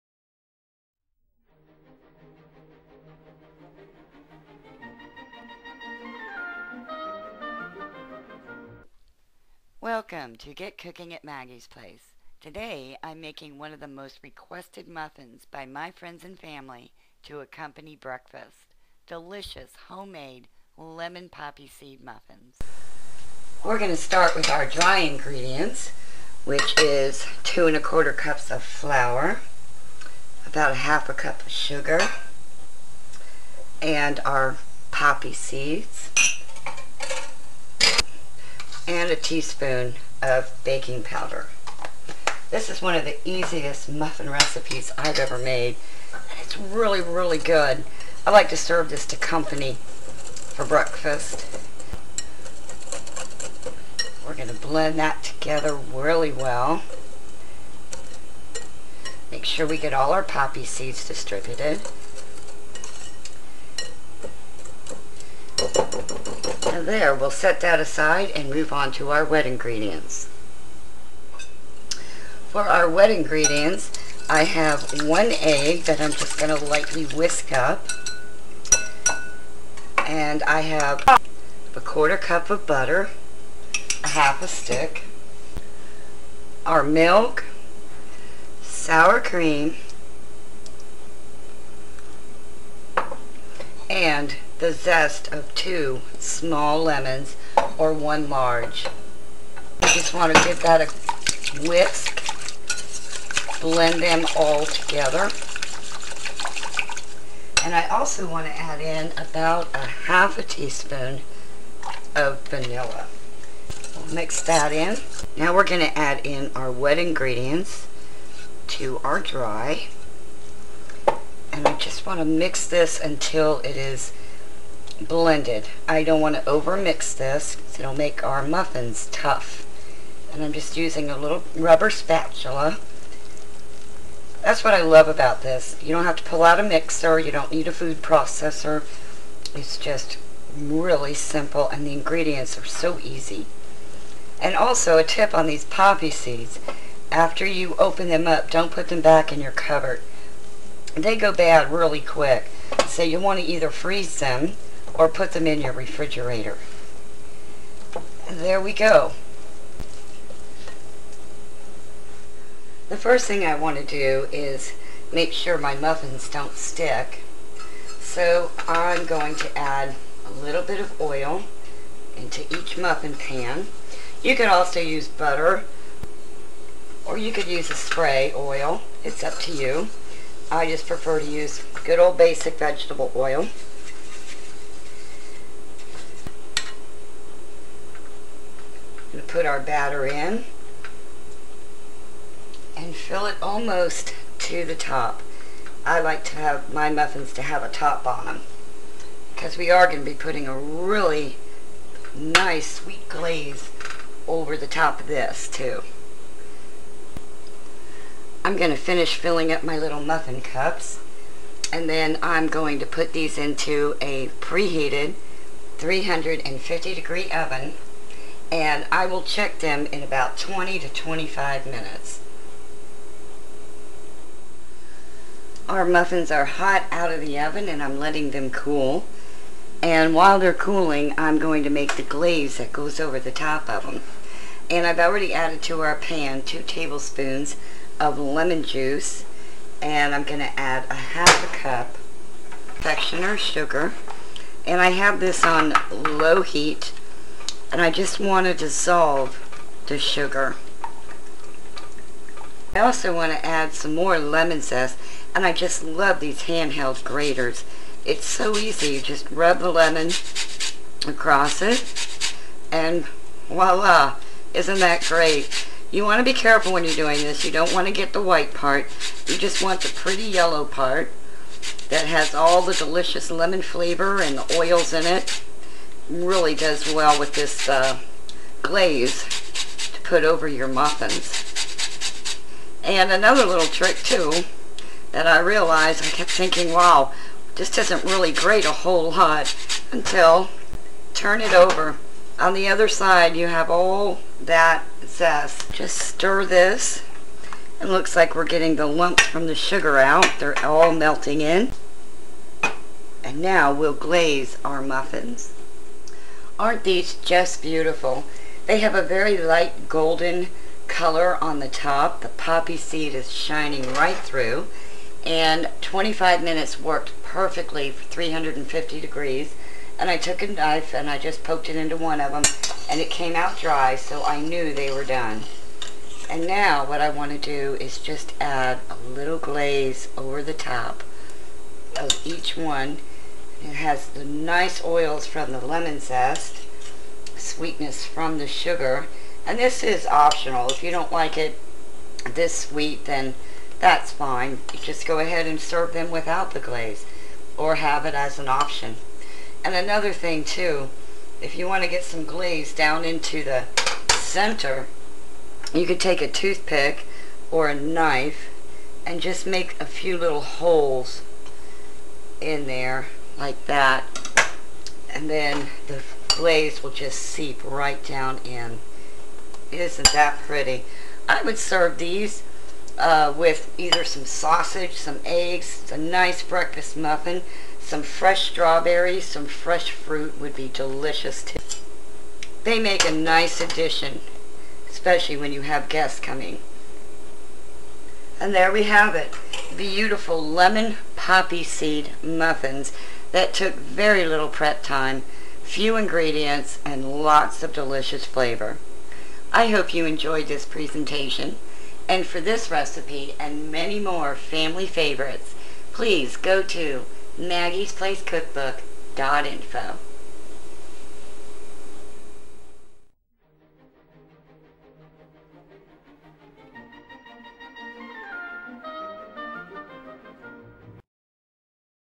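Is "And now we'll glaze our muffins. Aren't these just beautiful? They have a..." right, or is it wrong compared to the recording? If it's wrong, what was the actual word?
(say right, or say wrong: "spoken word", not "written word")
right.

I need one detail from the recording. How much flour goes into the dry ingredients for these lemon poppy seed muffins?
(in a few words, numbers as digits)
2 1/4 cups.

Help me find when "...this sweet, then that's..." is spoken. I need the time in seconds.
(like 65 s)
342 s.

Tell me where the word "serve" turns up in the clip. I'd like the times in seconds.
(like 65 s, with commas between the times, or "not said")
48 s, 345 s, 371 s.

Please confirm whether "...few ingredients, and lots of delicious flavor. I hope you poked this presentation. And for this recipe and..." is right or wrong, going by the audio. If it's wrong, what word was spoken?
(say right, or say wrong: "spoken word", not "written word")
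wrong: "enjoyed", not "poked".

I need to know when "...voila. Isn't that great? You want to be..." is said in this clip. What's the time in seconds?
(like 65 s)
263 s.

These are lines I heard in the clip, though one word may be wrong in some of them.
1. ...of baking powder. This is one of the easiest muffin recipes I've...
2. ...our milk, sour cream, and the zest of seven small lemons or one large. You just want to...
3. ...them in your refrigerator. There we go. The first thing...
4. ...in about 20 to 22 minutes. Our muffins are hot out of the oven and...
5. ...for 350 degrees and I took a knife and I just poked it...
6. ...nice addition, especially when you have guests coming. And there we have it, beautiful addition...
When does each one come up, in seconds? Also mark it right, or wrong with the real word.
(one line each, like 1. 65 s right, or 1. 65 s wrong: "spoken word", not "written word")
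1. 40 s right
2. 86 s wrong: "two", not "seven"
3. 155 s right
4. 219 s wrong: "25", not "22"
5. 317 s right
6. 383 s wrong: "lemon", not "addition".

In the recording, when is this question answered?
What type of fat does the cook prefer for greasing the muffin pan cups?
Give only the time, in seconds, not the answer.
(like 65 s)
182 s.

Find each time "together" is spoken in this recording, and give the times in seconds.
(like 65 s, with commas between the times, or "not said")
55 s, 104 s.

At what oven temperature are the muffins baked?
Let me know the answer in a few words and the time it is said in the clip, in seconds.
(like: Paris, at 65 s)
350 degrees, at 215 s.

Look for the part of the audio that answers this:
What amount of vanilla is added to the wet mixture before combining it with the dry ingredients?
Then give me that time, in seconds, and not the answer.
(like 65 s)
109 s.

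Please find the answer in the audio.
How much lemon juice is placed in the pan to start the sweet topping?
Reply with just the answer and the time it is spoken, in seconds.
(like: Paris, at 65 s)
2 tablespoons, at 236 s.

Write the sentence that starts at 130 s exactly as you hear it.
And I'm just using a little rubber spatula.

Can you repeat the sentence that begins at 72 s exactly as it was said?
For our wet ingredients, I have one egg that I'm just going to lightly whisk up.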